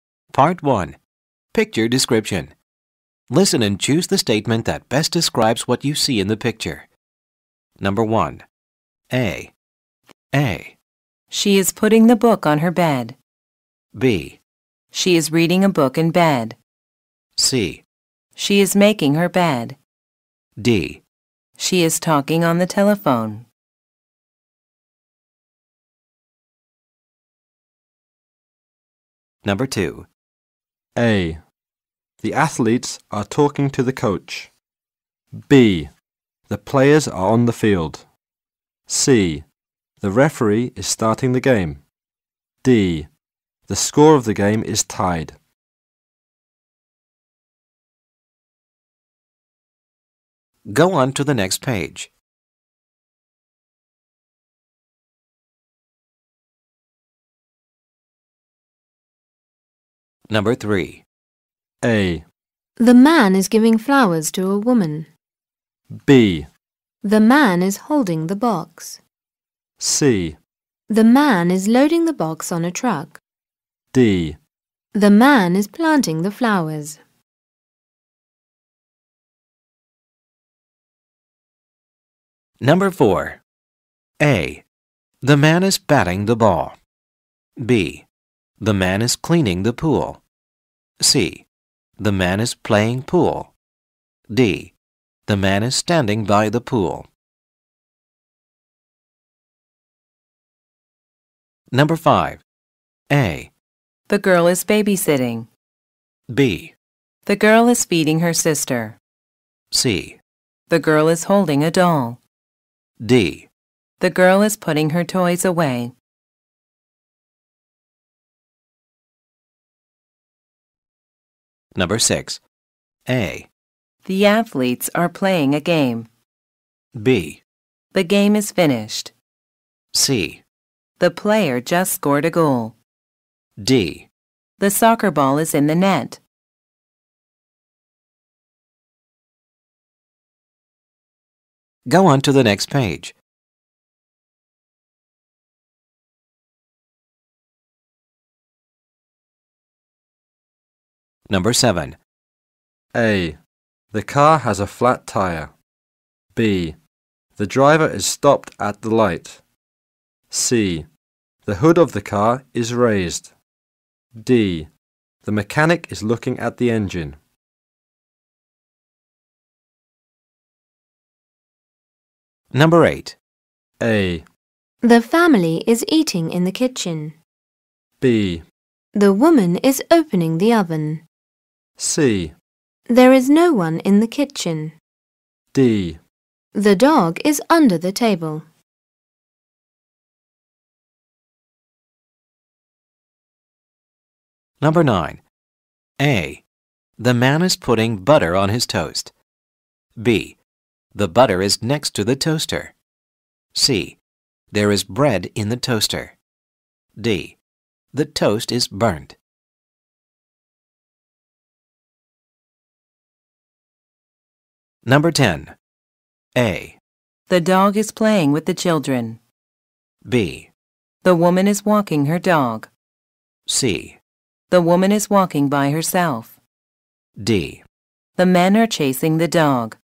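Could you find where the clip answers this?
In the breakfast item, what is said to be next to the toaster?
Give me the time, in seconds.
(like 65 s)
200 s.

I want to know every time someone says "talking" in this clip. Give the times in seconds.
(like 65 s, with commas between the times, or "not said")
21 s, 33 s.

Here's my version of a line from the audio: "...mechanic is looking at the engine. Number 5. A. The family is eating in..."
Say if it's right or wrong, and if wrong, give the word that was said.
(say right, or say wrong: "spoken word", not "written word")
wrong: "8", not "5".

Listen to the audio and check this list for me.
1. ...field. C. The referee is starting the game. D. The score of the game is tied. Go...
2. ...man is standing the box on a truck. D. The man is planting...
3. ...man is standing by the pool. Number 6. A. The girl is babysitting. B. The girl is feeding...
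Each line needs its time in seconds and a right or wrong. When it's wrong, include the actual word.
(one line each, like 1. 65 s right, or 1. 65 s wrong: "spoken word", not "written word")
1. 37 s right
2. 71 s wrong: "loading", not "standing"
3. 95 s wrong: "5", not "6".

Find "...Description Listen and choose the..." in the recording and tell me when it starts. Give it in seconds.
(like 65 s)
1 s.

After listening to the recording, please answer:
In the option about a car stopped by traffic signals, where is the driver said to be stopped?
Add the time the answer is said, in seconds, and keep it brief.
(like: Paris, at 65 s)
at the light, at 158 s.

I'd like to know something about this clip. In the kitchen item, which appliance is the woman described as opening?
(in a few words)
the oven.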